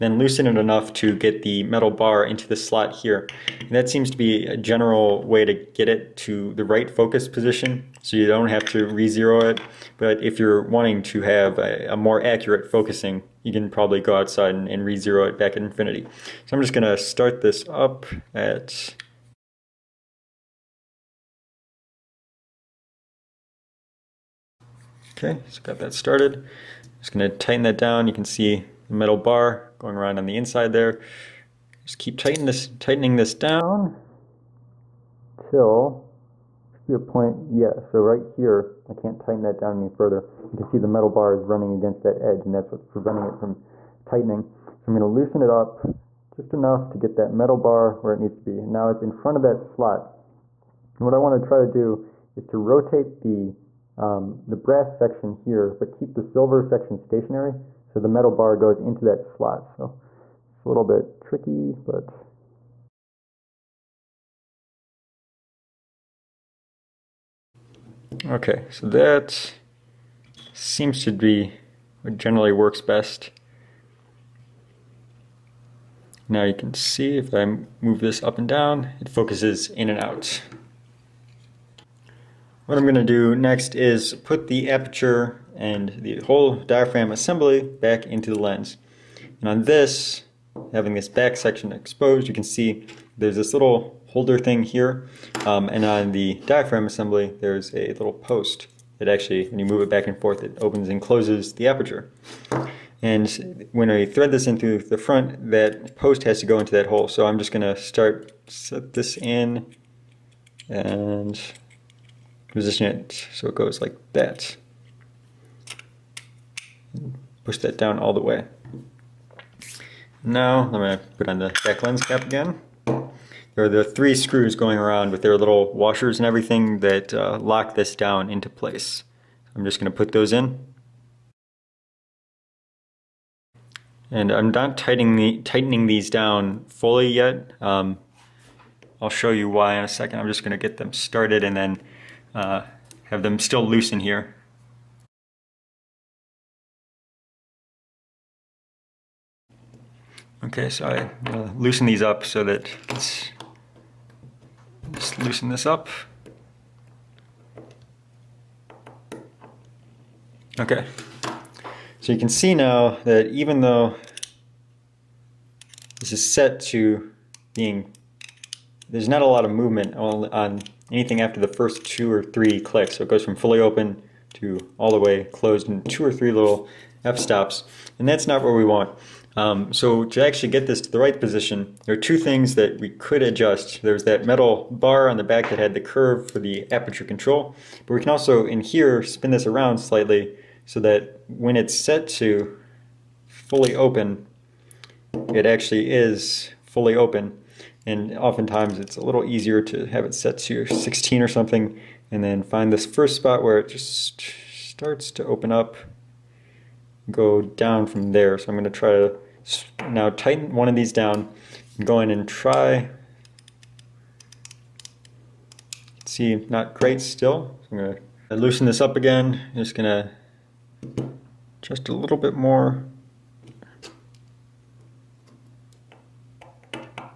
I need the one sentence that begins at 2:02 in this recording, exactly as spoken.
There are the three screws going around with their little washers and everything that uh, lock this down into place.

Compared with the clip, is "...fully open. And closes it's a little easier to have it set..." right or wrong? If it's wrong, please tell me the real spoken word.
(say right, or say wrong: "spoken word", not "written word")
wrong: "oftentimes", not "closes".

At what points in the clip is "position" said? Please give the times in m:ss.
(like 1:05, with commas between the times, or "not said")
0:07, 1:52, 3:01.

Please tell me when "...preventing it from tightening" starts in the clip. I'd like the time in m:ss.
0:42.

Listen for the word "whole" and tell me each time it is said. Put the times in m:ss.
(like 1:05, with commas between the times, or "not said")
1:26.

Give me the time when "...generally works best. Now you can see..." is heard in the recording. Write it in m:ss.
1:12.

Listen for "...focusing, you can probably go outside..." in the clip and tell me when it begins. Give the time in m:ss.
0:12.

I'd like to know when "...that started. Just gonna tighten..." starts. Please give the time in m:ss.
0:25.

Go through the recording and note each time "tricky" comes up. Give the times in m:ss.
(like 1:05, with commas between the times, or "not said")
1:01.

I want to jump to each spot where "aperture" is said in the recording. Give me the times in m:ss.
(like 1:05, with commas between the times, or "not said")
1:24, 1:41, 3:06.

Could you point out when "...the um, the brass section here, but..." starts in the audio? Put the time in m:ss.
0:53.